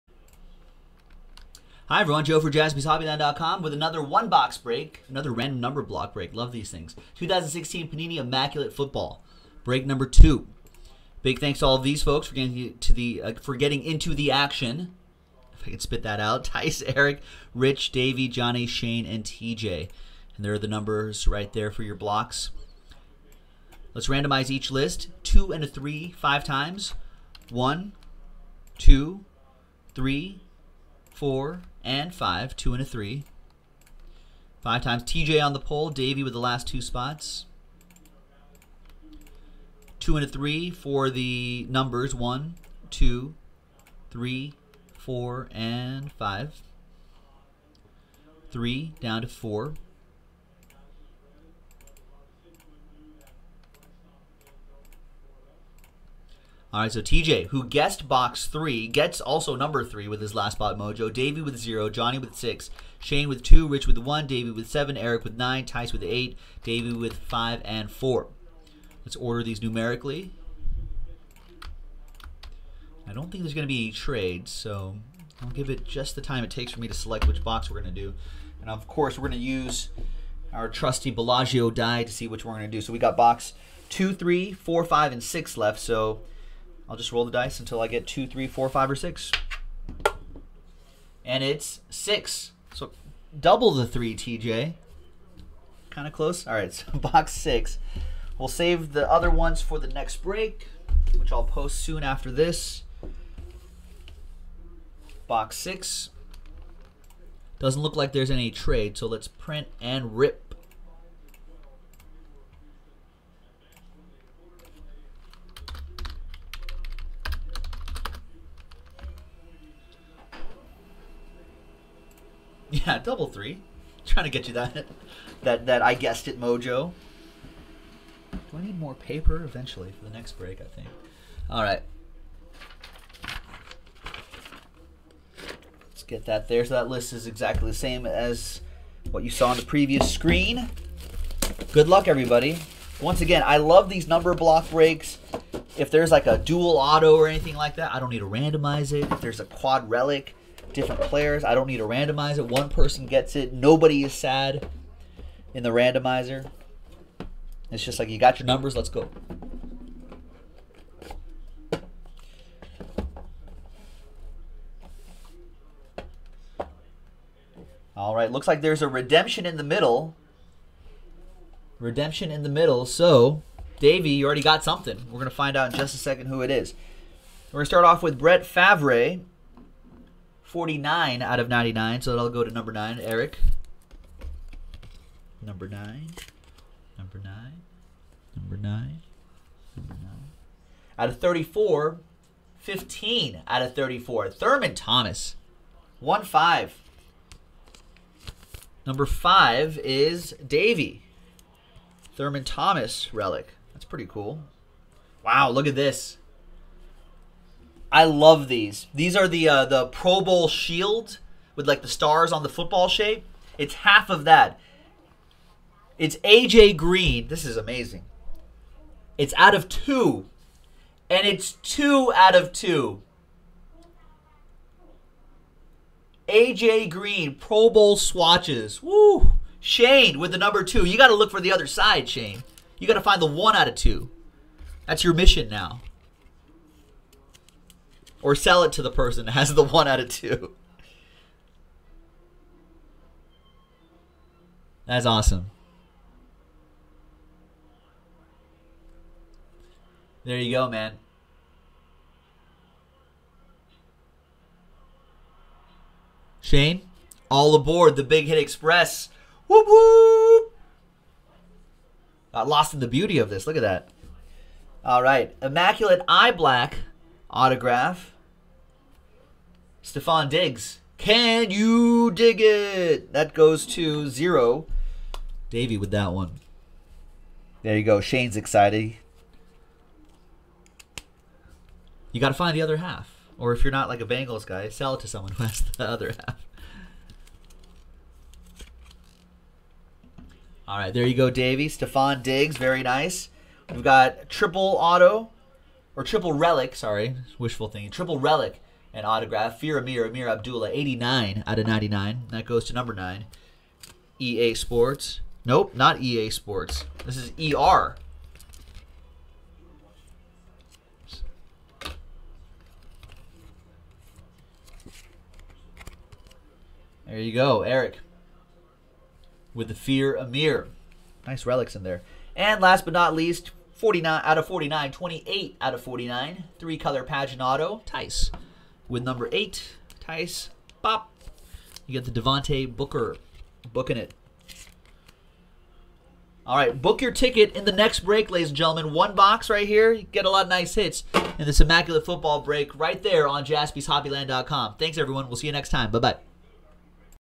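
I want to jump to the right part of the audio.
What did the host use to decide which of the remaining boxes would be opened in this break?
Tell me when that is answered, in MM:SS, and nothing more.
01:21.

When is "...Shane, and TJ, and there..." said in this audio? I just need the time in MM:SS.
00:18.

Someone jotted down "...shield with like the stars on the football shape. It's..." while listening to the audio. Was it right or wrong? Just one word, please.
right.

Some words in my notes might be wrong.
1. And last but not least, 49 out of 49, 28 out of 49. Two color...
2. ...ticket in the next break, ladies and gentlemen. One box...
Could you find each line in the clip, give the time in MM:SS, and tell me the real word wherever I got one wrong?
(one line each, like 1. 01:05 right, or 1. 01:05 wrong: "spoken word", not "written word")
1. 05:22 wrong: "Three", not "Two"
2. 05:37 right.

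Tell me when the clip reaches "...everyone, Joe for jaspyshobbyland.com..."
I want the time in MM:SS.
00:01.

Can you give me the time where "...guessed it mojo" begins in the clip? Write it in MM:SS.
02:05.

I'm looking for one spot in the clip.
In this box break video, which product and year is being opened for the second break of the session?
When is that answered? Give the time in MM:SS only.
00:07.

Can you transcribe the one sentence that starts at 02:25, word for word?
If there's like a dual auto or anything like that, I don't need to randomize it.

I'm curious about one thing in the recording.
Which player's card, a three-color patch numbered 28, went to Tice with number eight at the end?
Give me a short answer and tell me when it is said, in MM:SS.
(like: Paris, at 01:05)
Devontae Booker, at 05:32.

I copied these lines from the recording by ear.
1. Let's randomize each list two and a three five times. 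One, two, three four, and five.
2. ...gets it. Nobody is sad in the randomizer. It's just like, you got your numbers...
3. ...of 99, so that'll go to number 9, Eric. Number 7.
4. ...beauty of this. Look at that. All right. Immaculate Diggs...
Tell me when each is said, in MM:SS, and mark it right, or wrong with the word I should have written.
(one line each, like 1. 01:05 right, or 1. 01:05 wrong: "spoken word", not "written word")
1. 00:23 right
2. 02:33 right
3. 03:01 wrong: "9", not "7"
4. 04:22 wrong: "Eye", not "Diggs".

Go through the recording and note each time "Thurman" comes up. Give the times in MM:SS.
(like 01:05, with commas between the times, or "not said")
03:14, 03:22.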